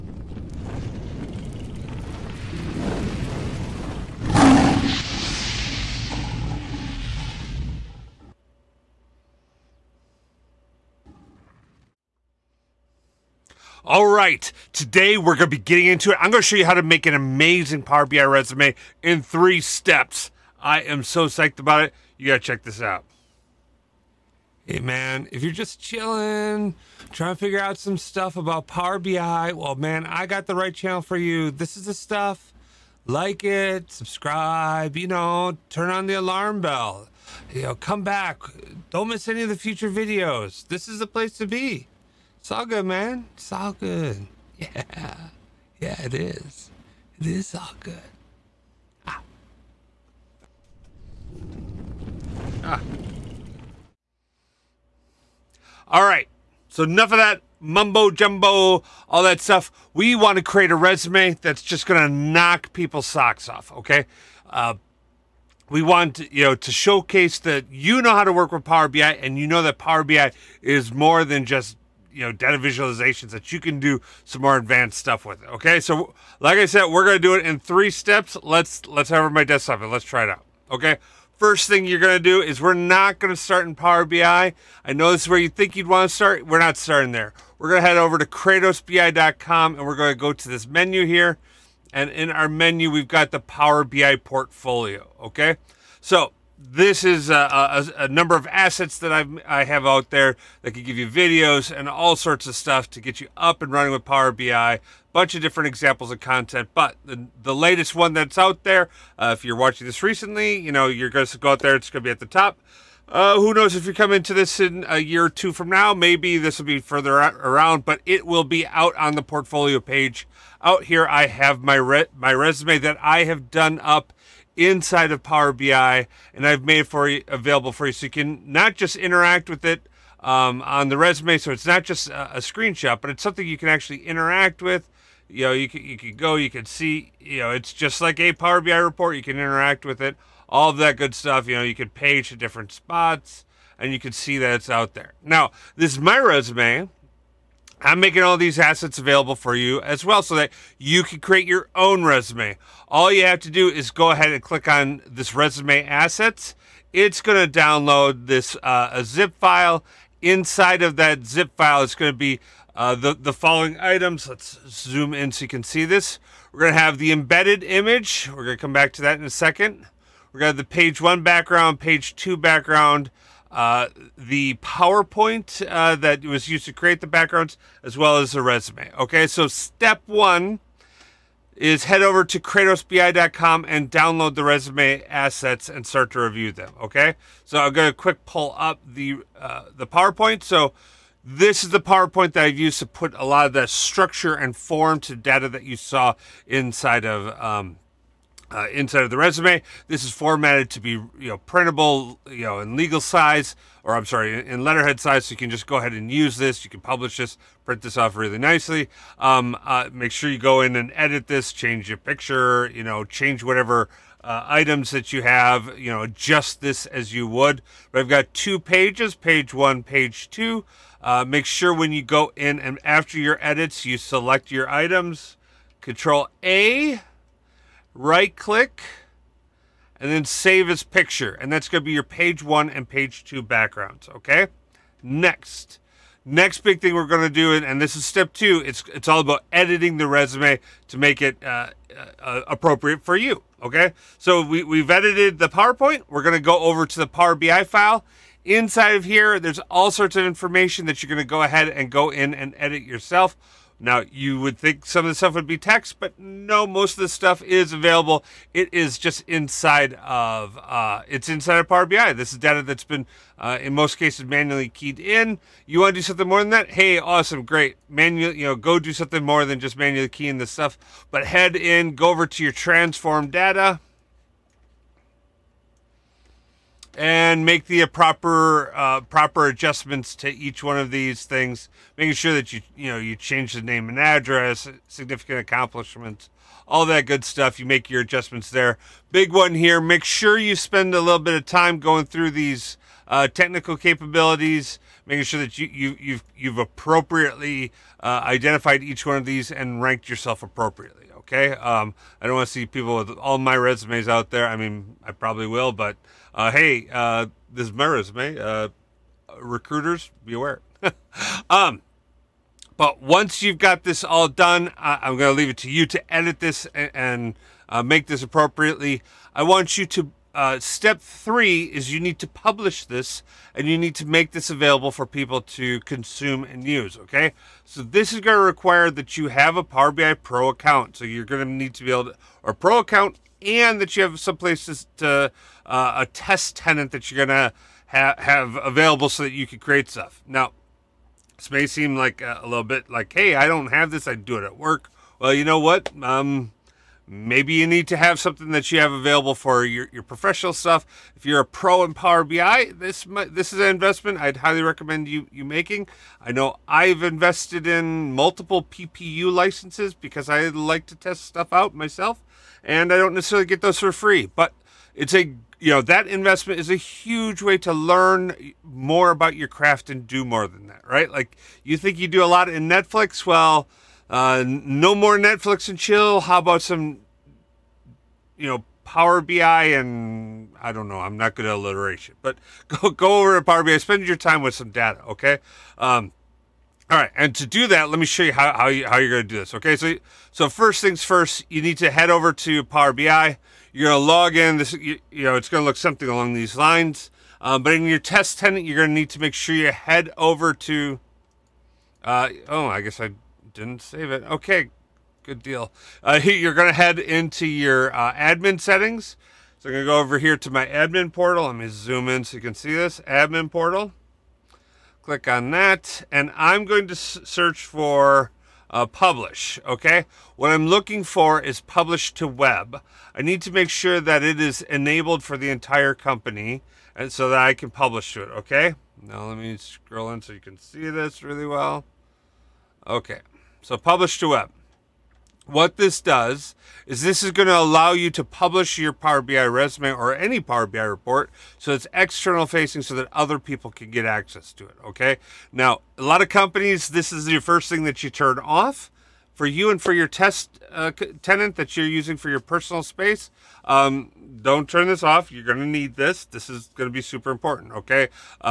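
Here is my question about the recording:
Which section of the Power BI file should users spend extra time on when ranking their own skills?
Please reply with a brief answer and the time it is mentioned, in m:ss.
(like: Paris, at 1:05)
technical capabilities, at 4:53.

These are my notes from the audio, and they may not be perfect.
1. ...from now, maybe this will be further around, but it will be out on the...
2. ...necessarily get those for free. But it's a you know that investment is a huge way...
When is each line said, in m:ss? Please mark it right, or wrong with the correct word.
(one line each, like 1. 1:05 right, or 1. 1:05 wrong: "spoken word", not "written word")
1. 1:55 right
2. 6:03 right.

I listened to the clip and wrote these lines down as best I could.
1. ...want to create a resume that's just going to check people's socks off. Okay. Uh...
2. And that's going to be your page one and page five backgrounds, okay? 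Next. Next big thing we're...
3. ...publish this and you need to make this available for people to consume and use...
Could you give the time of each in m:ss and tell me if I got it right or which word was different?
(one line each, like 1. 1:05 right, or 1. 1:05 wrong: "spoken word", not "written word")
1. 1:00 wrong: "knock", not "check"
2. 3:51 wrong: "two", not "five"
3. 5:22 right.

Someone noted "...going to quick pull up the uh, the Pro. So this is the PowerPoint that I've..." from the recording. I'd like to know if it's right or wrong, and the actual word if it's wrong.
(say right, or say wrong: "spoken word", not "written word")
wrong: "PowerPoint", not "Pro".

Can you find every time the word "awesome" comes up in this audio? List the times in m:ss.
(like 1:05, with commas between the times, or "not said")
4:26.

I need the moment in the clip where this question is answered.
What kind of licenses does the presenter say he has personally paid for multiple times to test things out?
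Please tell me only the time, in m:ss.
5:58.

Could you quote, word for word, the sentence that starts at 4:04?
So we, we've edited the PowerPoint.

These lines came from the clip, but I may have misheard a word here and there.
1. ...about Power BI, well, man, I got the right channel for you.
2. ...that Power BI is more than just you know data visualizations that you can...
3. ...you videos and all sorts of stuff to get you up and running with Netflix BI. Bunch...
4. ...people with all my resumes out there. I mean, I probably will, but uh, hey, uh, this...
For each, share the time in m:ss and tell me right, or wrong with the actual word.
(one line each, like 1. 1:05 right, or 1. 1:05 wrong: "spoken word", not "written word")
1. 0:28 right
2. 1:09 right
3. 1:40 wrong: "Power", not "Netflix"
4. 5:02 right.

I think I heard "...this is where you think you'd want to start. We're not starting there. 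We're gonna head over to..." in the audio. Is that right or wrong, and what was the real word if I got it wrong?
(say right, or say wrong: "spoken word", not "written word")
right.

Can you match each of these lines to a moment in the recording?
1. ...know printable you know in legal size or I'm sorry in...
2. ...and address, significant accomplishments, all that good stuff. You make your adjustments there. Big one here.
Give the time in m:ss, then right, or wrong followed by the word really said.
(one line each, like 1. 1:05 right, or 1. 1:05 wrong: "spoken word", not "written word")
1. 3:21 right
2. 4:43 right.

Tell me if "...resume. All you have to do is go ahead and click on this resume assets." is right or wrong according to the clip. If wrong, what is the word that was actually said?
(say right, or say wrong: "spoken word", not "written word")
right.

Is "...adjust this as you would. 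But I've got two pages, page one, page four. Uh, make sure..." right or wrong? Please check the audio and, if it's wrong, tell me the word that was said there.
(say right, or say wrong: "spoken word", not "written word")
wrong: "two", not "four".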